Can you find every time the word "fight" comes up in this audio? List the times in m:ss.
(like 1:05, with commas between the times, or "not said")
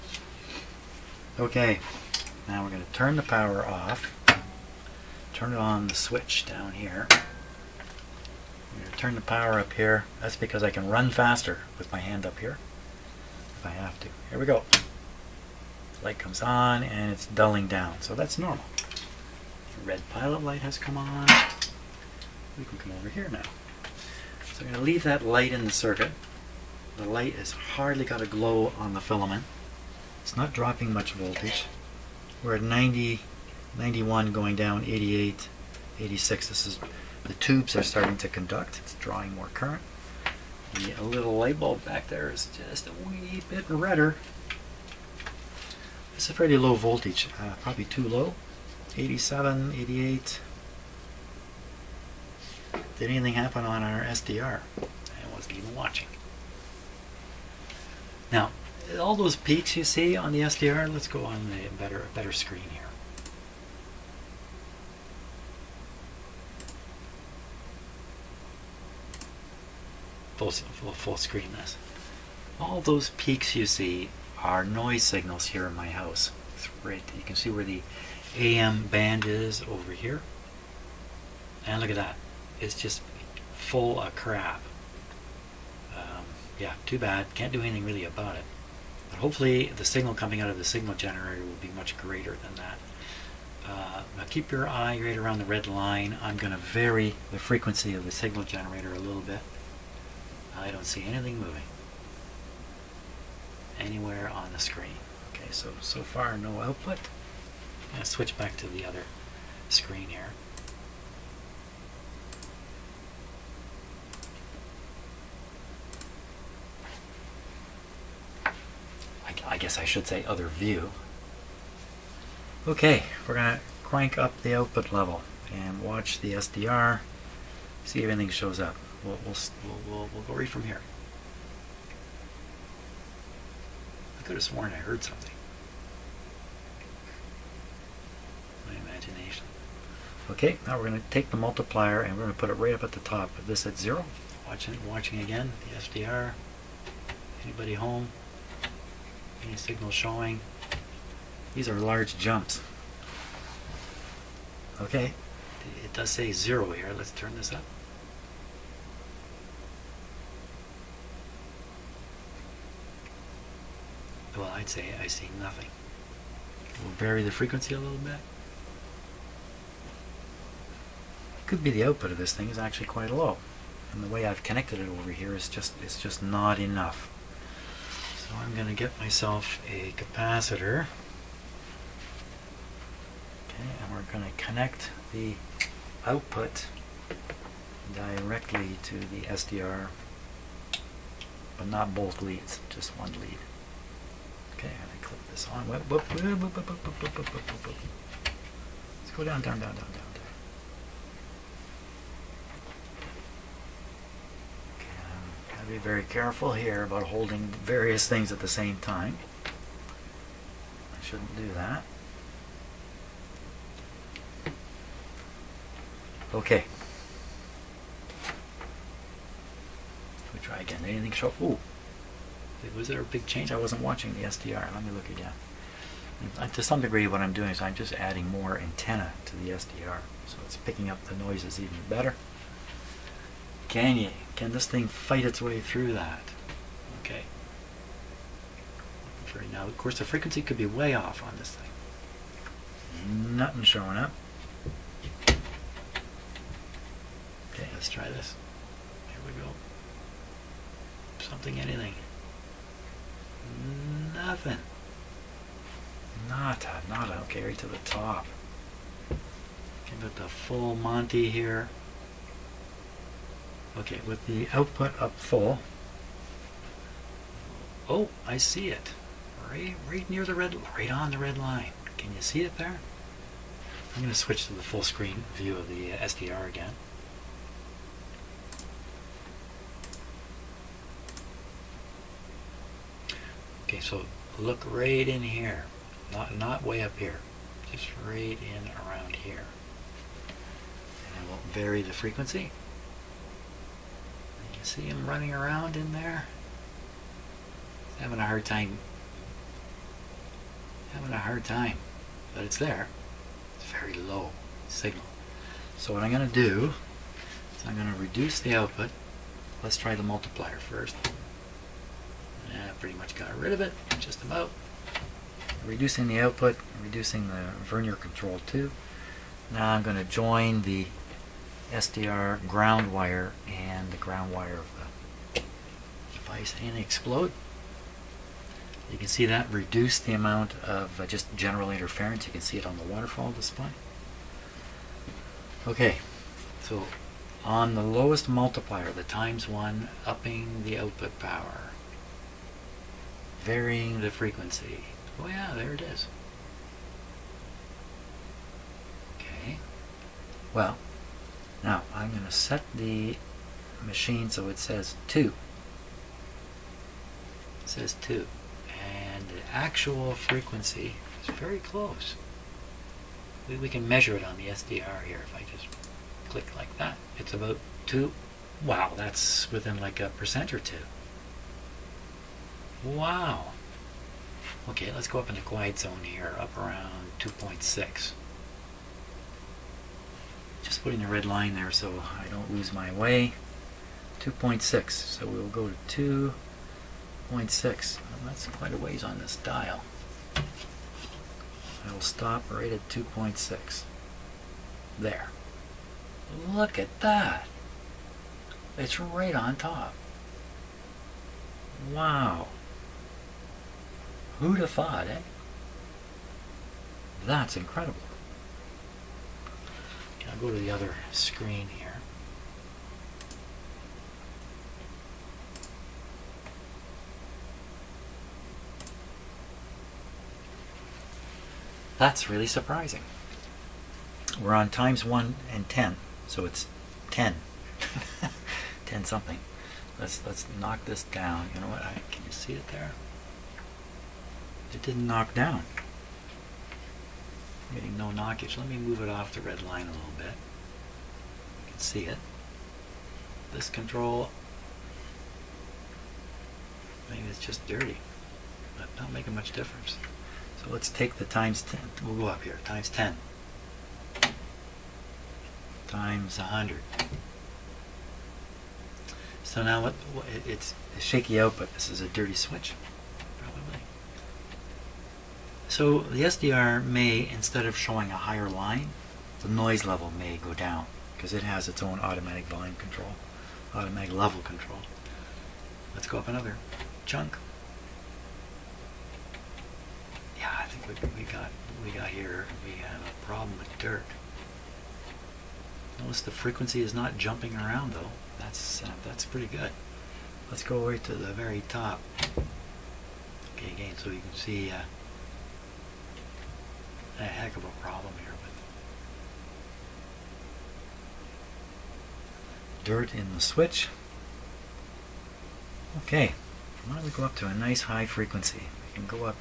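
3:54.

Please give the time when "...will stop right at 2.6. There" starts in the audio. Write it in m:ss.
6:31.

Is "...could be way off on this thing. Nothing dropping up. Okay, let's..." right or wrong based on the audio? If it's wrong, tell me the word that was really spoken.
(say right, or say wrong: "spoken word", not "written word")
wrong: "showing", not "dropping".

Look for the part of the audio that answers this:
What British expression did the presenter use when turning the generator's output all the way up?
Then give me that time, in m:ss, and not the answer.
4:20.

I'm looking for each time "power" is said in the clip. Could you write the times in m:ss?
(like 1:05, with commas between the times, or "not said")
0:03, 0:09, 5:41.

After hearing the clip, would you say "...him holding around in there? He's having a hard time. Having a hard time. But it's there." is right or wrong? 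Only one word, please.
wrong.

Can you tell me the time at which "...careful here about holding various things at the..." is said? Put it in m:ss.
3:26.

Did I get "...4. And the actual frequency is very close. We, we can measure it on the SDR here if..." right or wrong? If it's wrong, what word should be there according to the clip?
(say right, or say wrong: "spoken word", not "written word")
wrong: "2", not "4".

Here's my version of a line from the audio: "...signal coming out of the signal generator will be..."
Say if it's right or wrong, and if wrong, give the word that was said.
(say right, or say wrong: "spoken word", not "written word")
right.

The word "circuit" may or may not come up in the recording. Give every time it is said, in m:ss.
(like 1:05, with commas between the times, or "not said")
0:25.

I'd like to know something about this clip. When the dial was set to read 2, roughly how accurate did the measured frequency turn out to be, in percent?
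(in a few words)
1 or 2 percent.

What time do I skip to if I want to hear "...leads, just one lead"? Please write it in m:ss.
3:12.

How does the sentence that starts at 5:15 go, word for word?
Reducing the output, reducing the vernier control too.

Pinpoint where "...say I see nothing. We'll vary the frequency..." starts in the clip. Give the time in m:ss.
2:44.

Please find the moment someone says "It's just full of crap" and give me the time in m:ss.
1:22.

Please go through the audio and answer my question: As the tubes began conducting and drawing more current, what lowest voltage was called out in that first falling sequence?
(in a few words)
86.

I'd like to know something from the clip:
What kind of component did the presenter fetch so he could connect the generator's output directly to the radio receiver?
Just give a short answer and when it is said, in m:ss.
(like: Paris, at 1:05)
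A capacitor, at 2:59.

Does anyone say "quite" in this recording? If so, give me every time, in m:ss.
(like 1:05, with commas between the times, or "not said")
2:52, 6:28.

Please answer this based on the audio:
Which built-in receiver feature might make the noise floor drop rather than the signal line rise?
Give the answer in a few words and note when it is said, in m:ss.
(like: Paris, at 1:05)
Automatic level control, at 7:53.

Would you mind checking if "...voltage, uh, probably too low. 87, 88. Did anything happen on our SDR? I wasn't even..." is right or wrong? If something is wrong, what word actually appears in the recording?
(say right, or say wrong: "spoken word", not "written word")
right.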